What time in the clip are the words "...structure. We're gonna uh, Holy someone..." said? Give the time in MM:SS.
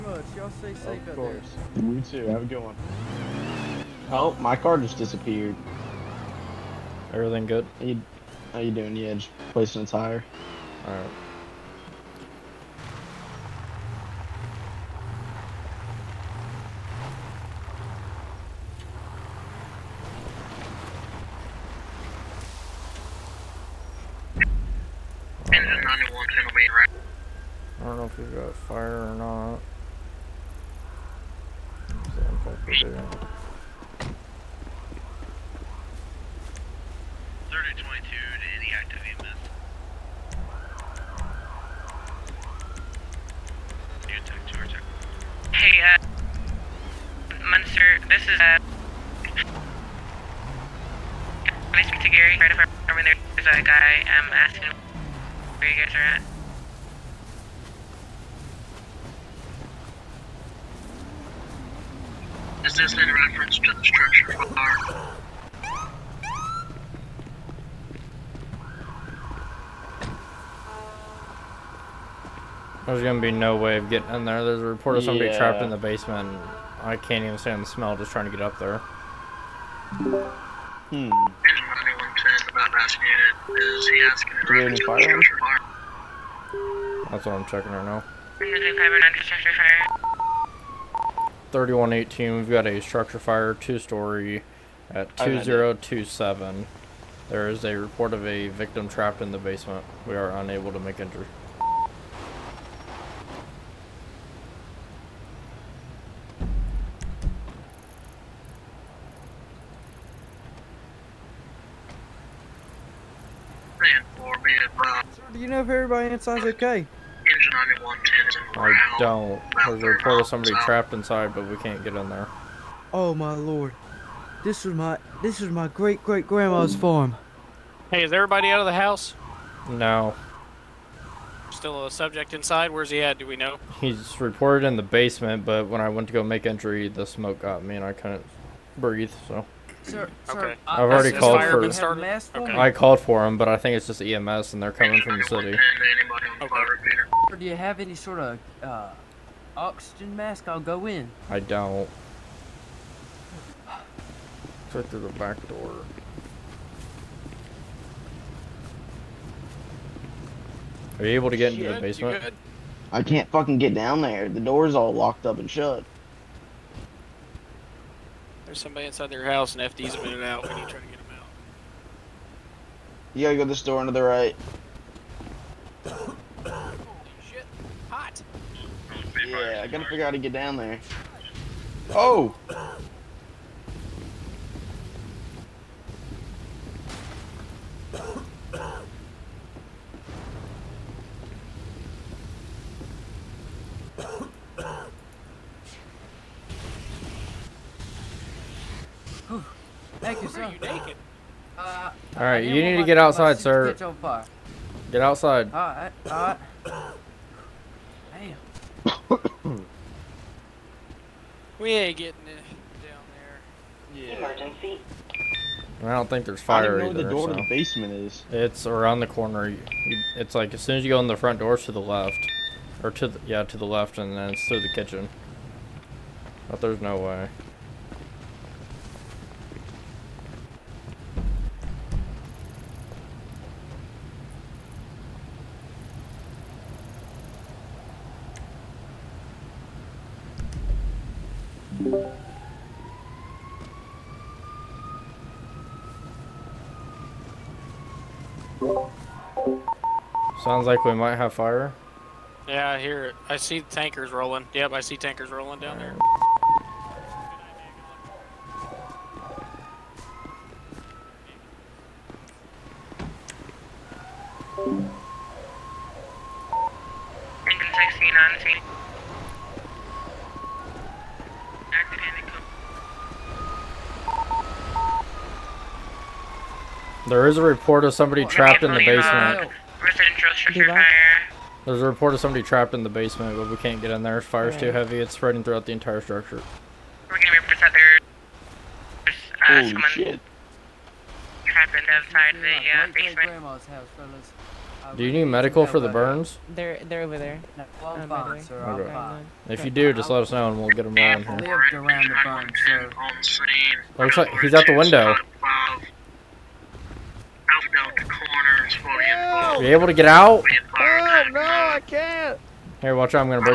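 04:45.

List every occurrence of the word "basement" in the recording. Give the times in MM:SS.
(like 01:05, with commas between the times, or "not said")
01:15, 01:39, 02:14, 02:41, 03:37, 04:38, 04:42.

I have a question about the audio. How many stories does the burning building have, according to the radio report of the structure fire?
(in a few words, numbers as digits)
2.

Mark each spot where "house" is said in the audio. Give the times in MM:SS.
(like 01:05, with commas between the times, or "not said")
02:08, 02:49.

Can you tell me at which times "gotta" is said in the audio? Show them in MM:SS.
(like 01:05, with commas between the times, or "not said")
02:53, 02:59.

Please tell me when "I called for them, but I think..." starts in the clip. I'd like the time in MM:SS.
02:22.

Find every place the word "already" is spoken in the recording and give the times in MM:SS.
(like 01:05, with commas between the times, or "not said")
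02:20.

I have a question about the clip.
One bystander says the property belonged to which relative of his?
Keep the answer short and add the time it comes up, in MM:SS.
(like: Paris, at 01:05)
great great grandma, at 02:05.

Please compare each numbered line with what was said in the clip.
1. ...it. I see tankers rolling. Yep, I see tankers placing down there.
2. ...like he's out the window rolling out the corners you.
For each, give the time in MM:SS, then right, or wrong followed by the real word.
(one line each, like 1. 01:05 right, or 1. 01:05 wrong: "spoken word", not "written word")
1. 04:13 wrong: "rolling", not "placing"
2. 05:04 wrong: "watching", not "rolling".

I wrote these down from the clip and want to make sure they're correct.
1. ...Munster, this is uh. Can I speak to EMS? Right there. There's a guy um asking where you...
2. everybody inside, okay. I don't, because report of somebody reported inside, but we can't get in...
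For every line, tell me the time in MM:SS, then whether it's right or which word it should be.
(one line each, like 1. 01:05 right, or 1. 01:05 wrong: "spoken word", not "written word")
1. 00:47 wrong: "Gary", not "EMS"
2. 01:55 wrong: "trapped", not "reported".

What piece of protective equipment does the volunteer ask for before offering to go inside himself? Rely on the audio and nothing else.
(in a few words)
oxygen mask.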